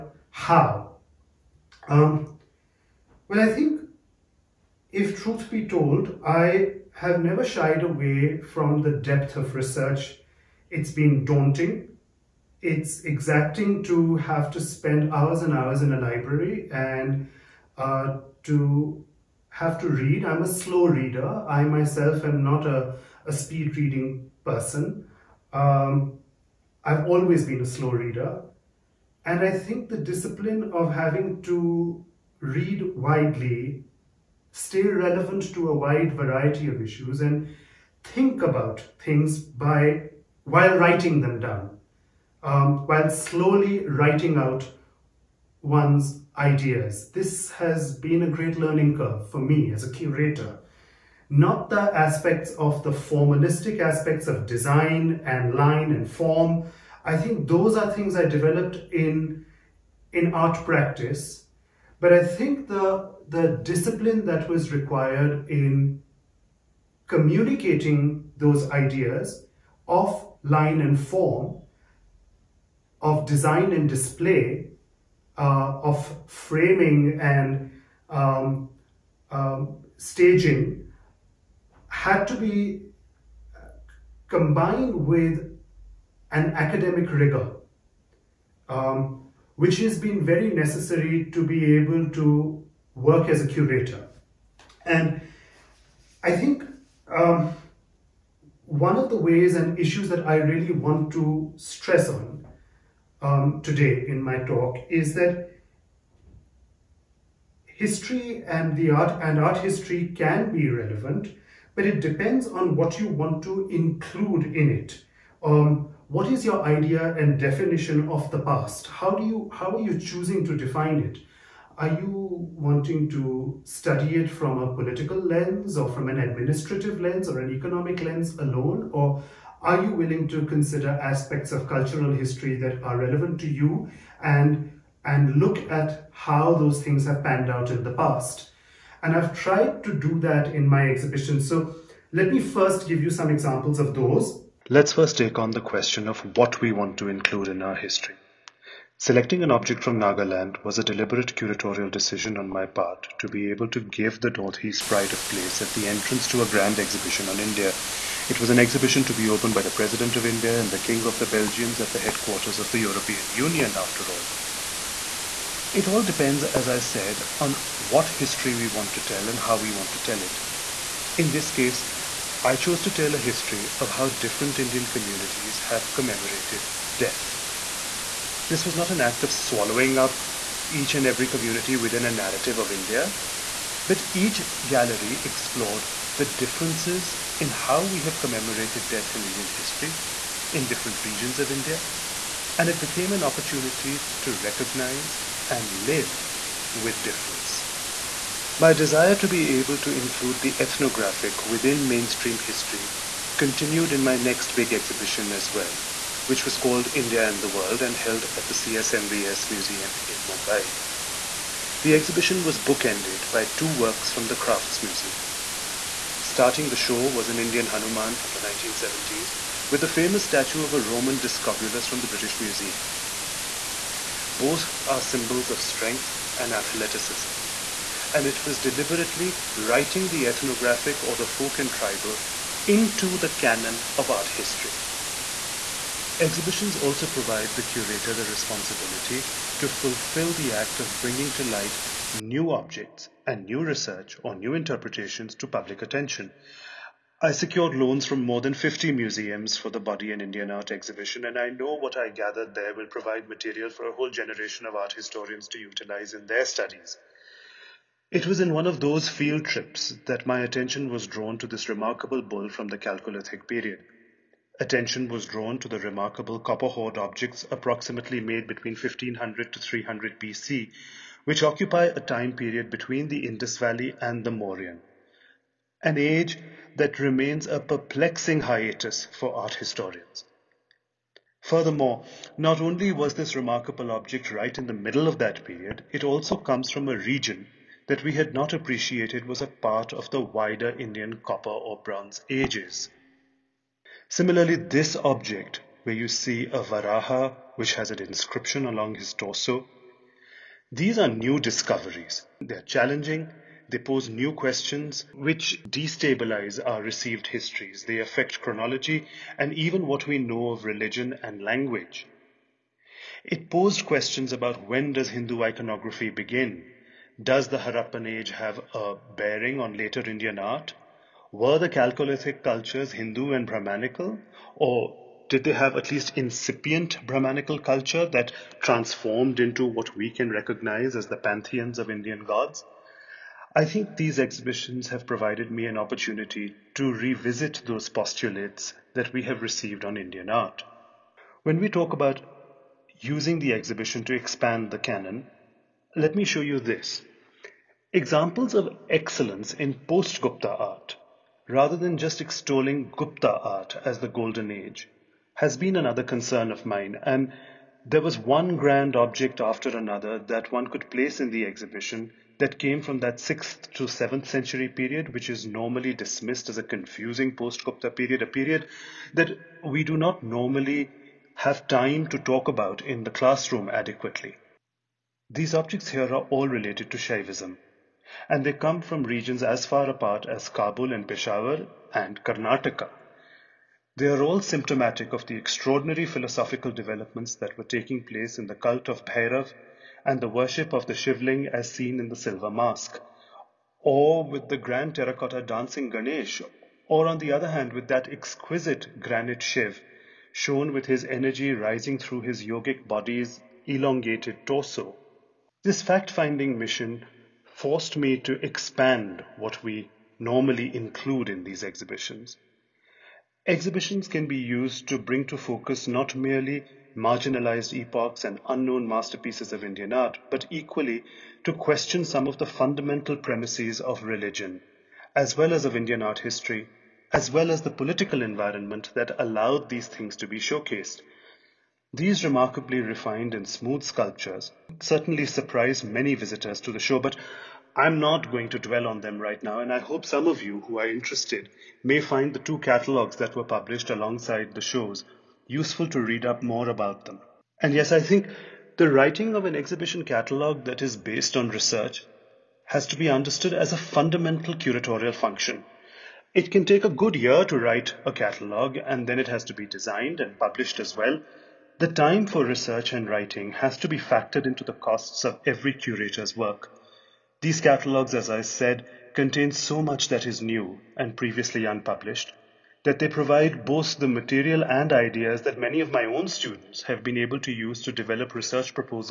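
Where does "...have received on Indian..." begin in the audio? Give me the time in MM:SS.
05:39.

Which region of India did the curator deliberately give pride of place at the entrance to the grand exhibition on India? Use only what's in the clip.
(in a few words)
The Northeast.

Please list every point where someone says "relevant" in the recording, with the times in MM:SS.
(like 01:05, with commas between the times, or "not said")
00:34, 01:50, 02:12.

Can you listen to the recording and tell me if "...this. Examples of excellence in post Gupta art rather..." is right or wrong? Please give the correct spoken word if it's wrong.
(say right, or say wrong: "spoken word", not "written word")
right.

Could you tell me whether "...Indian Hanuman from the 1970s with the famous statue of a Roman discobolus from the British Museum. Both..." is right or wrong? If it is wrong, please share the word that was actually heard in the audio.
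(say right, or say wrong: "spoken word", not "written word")
right.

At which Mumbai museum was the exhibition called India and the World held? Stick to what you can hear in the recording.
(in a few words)
CSMVS Museum.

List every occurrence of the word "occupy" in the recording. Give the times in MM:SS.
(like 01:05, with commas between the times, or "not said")
04:31.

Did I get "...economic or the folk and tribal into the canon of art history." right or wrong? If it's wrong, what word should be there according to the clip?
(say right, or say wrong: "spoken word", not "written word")
wrong: "ethnographic", not "economic".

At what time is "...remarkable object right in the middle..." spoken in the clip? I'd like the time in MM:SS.
04:43.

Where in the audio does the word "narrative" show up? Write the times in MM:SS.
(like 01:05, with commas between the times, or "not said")
03:02.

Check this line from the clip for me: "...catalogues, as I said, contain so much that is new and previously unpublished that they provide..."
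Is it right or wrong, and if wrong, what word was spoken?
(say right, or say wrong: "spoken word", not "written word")
right.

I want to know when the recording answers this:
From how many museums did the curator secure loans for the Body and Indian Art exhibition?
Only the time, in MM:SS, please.
04:08.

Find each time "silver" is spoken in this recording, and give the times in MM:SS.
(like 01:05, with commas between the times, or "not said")
06:32.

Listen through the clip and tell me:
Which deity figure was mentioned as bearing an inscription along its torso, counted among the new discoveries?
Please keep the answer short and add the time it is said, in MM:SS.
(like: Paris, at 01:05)
Varaha, at 04:56.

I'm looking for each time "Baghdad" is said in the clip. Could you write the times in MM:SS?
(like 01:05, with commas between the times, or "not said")
not said.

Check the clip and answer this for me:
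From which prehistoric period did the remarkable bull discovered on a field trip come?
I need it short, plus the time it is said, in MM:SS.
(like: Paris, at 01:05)
Chalcolithic period, at 04:22.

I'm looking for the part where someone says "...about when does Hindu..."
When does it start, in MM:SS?
05:14.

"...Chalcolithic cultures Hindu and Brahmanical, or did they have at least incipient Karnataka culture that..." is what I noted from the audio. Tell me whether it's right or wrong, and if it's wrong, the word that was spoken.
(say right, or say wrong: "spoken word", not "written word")
wrong: "Brahmanical", not "Karnataka".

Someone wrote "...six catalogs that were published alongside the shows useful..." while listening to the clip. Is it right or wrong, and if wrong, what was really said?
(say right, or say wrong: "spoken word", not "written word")
wrong: "two", not "six".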